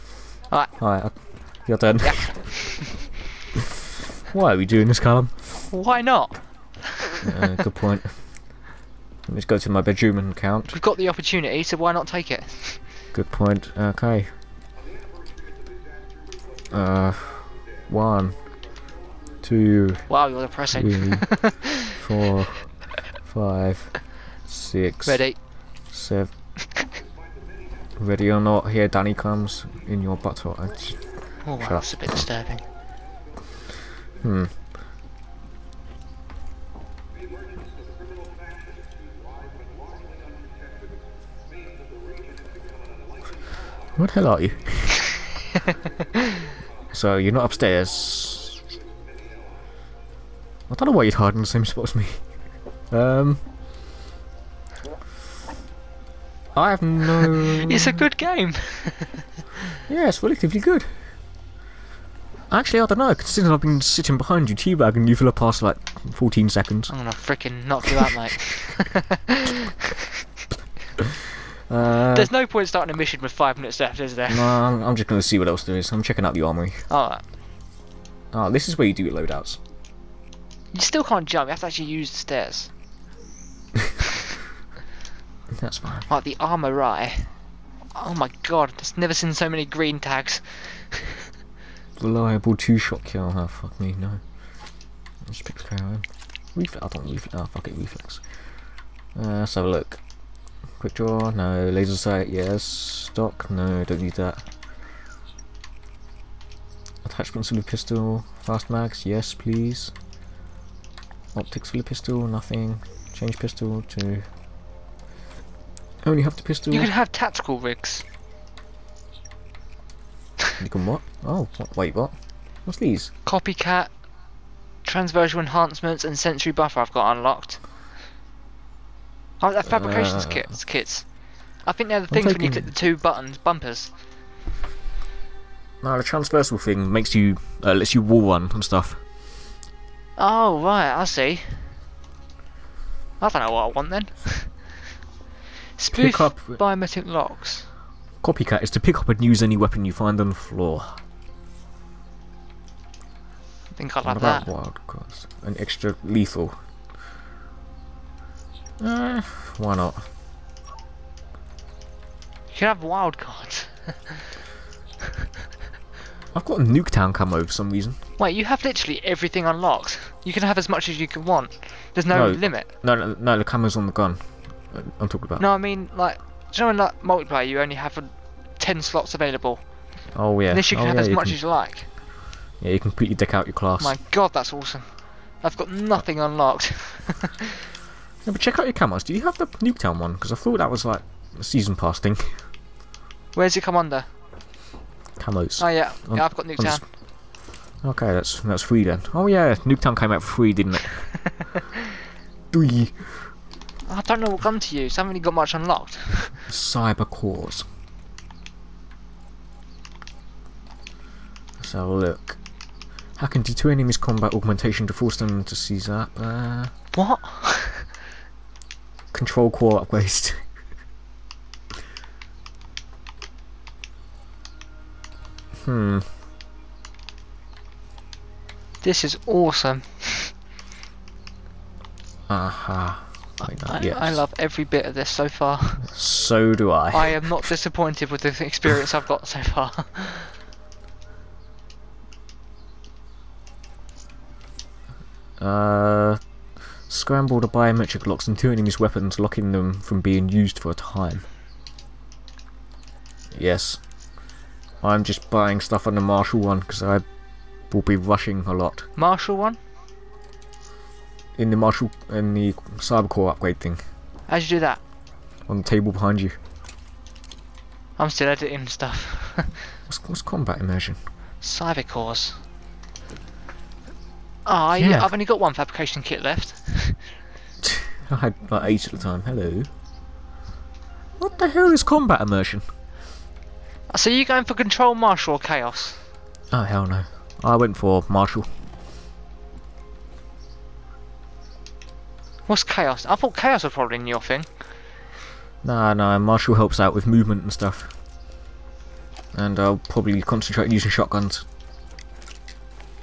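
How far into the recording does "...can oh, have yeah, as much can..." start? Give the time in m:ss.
3:00.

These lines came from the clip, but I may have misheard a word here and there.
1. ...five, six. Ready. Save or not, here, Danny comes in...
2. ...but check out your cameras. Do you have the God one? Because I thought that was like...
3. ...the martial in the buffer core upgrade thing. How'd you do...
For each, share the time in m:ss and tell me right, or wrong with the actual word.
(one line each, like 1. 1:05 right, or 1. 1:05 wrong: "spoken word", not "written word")
1. 0:23 right
2. 3:08 wrong: "Nuketown", not "God"
3. 4:21 wrong: "cyber", not "buffer".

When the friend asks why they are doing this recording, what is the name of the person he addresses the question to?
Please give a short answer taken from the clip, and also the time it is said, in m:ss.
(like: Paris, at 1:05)
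Callum, at 0:04.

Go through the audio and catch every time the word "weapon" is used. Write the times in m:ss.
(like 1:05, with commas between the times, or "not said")
2:29, 4:08.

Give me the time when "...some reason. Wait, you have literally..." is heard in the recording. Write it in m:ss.
2:47.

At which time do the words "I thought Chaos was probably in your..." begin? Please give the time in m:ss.
4:53.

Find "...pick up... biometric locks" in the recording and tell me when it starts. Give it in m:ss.
2:26.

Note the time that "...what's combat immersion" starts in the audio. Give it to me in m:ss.
4:30.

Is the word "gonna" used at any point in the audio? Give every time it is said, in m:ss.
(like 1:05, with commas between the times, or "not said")
1:06, 1:15.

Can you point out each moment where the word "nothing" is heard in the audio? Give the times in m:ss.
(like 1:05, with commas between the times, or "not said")
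1:52, 3:05.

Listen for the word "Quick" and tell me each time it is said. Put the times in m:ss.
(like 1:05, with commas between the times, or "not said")
1:40.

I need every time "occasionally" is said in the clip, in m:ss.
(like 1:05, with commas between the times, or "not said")
not said.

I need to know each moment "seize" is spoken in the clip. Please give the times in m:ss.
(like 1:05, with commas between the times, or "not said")
3:35.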